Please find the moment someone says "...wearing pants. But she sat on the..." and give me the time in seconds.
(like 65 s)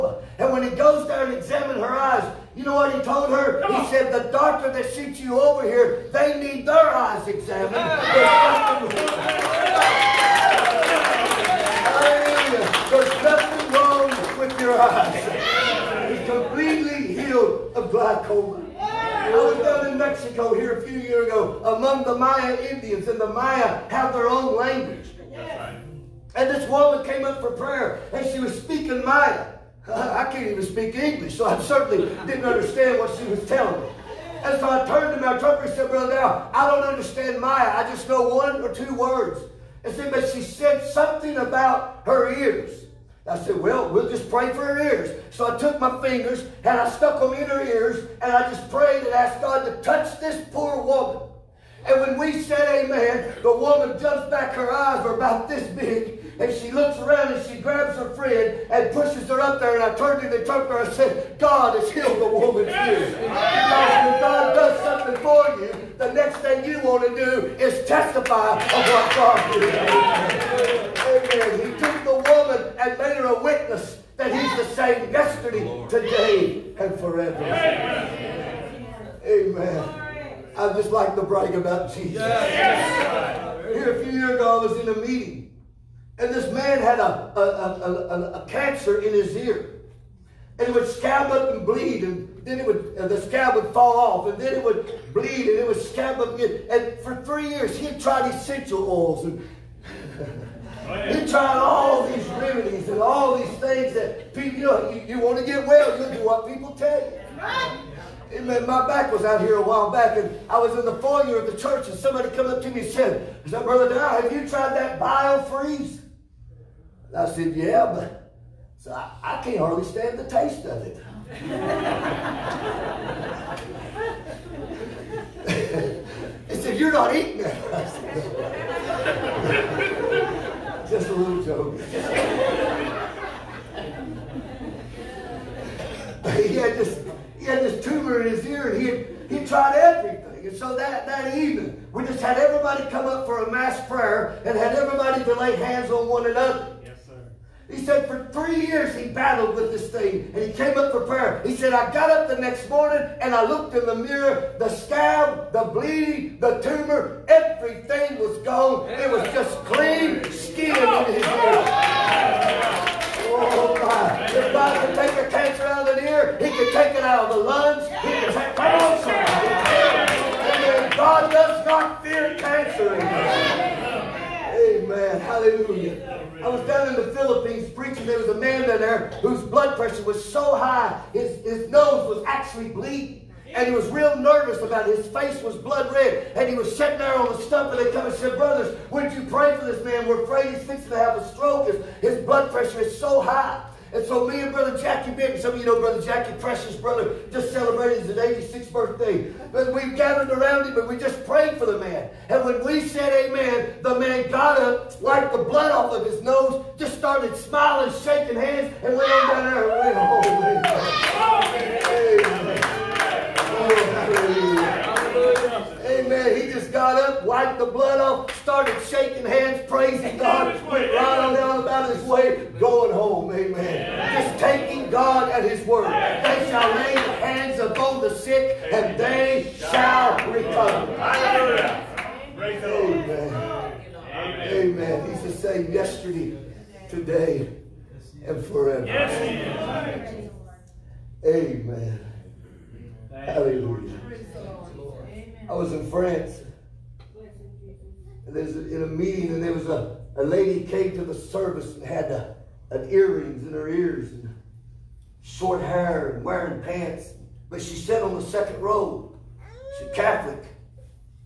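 256 s.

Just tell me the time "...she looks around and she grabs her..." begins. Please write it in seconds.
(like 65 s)
56 s.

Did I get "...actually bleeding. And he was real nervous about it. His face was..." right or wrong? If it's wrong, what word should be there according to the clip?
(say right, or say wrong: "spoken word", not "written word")
right.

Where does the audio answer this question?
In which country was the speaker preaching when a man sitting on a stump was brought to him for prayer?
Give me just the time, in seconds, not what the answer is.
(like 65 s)
177 s.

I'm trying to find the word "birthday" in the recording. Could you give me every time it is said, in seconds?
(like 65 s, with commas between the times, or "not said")
198 s.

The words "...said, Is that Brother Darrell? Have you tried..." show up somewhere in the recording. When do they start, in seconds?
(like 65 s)
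112 s.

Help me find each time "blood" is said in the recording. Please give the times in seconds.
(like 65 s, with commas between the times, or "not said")
179 s, 185 s, 192 s, 205 s, 217 s.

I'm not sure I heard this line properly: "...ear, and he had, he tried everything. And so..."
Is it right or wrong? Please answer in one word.
right.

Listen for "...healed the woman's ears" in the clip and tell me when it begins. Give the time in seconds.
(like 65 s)
61 s.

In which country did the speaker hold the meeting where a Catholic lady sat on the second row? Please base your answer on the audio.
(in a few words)
France.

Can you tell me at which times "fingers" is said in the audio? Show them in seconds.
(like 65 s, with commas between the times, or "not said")
46 s.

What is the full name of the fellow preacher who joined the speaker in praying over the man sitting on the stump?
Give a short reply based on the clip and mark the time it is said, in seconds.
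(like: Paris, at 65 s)
Jackie Benton, at 194 s.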